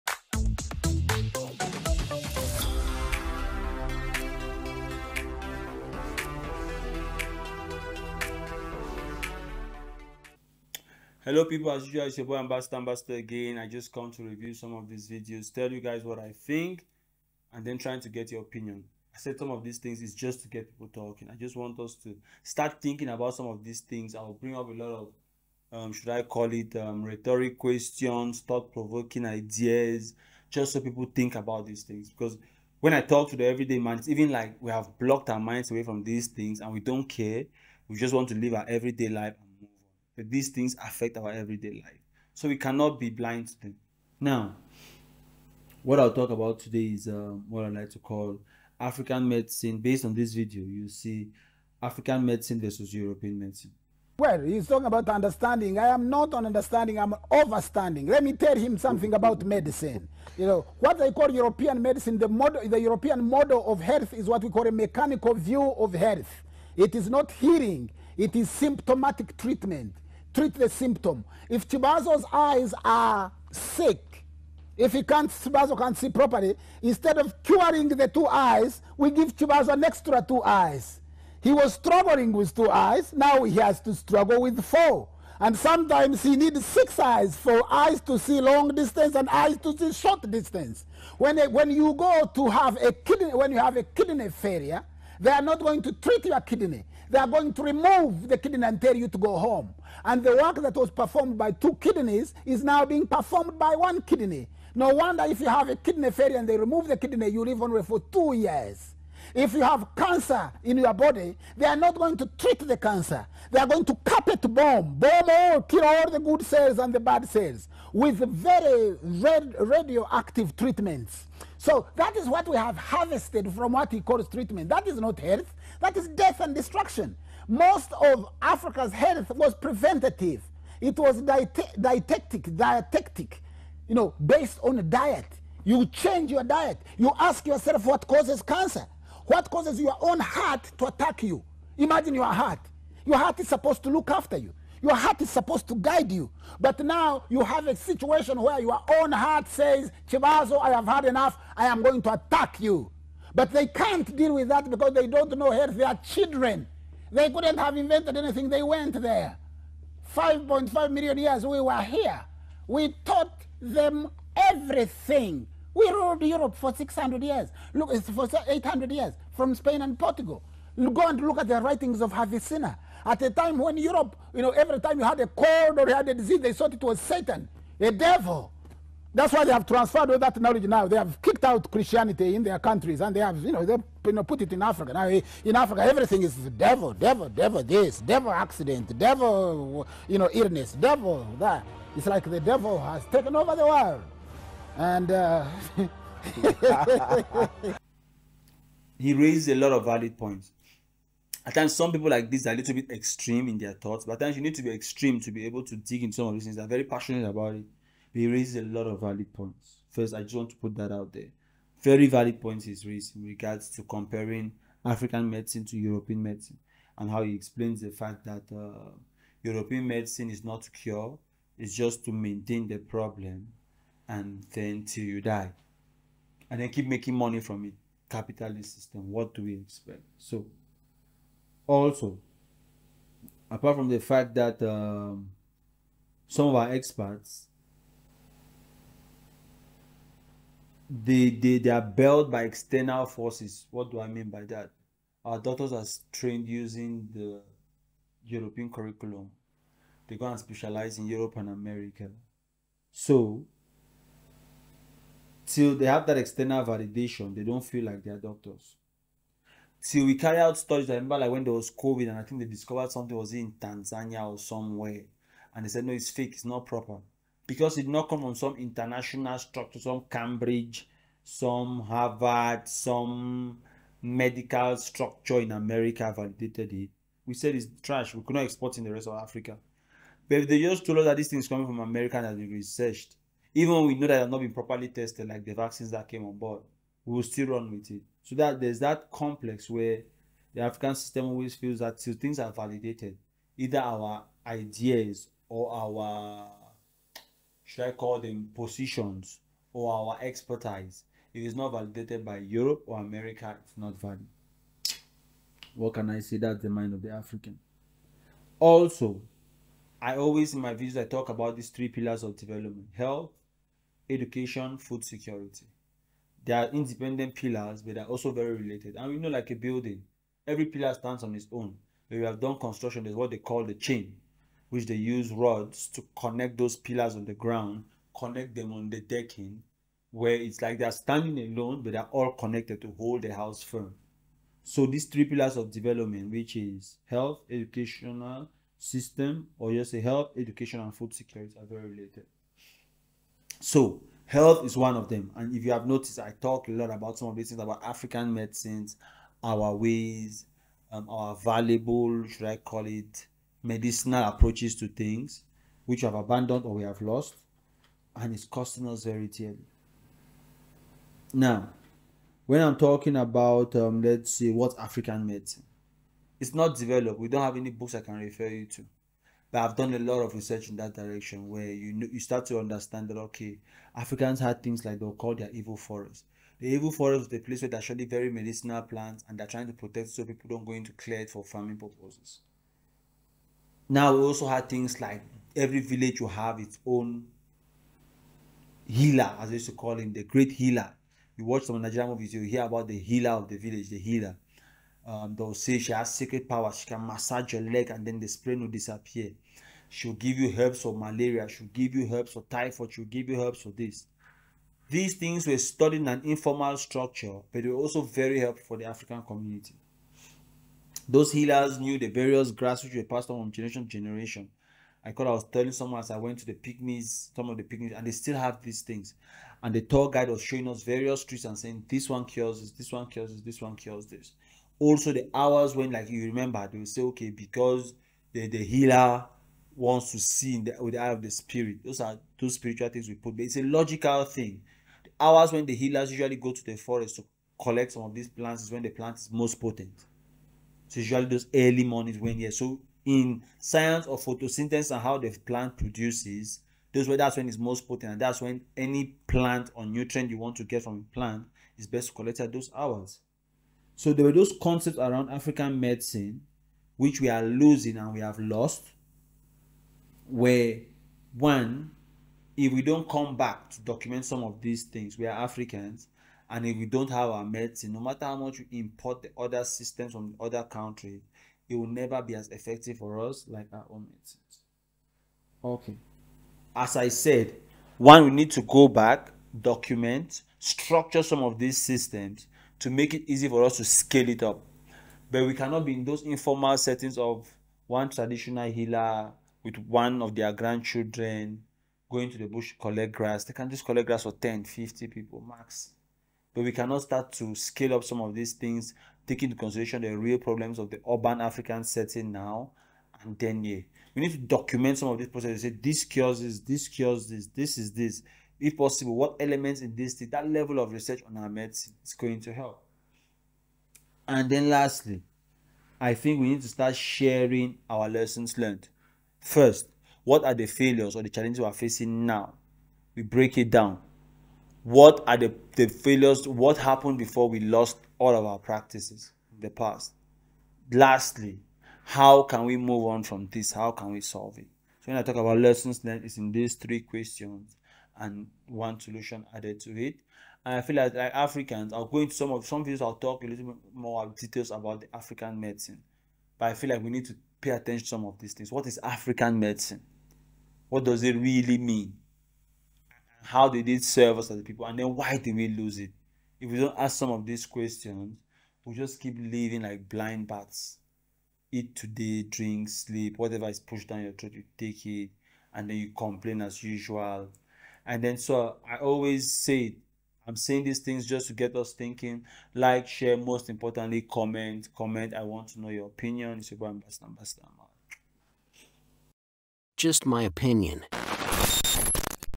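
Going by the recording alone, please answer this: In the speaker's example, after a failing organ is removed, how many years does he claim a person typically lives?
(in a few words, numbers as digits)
2 years.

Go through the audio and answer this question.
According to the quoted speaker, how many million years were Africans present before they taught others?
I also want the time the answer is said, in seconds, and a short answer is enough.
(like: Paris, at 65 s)
5.5 million, at 160 s.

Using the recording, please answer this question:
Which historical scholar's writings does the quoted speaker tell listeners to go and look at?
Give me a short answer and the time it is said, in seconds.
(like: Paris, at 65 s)
Avicenna, at 172 s.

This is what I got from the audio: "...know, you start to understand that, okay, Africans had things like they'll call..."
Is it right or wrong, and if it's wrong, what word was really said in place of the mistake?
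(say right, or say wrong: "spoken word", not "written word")
right.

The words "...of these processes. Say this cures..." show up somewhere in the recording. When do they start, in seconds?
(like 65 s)
505 s.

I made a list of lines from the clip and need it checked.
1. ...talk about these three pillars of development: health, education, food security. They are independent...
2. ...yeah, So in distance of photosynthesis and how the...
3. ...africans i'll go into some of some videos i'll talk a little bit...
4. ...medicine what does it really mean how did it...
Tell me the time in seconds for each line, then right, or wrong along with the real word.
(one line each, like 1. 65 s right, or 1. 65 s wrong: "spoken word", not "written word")
1. 311 s right
2. 442 s wrong: "science", not "distance"
3. 541 s right
4. 549 s right.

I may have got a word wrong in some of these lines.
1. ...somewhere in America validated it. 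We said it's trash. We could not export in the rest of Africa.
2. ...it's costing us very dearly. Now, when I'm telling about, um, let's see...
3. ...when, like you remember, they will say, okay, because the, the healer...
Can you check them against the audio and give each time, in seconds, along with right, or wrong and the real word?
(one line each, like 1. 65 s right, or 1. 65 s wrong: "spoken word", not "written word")
1. 274 s wrong: "structure", not "somewhere"
2. 358 s wrong: "talking", not "telling"
3. 425 s right.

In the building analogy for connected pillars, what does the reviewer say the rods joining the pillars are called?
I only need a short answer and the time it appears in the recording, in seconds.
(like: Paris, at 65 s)
the chain, at 323 s.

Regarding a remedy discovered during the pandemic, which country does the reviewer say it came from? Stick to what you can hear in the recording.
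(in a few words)
Tanzania.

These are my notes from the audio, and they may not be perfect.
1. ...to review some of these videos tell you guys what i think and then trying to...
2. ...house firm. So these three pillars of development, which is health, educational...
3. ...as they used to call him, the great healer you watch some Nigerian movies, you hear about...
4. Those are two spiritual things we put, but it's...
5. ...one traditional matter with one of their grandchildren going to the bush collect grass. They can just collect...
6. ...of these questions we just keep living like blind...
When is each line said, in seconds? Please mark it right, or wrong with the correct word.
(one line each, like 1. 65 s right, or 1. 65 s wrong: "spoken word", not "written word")
1. 14 s right
2. 333 s right
3. 389 s right
4. 431 s right
5. 487 s wrong: "healer", not "matter"
6. 557 s right.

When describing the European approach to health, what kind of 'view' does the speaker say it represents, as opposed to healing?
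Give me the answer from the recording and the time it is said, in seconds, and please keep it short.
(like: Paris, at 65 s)
mechanical view, at 64 s.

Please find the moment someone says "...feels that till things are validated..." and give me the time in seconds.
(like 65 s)
291 s.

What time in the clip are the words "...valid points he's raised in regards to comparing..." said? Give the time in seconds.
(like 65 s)
212 s.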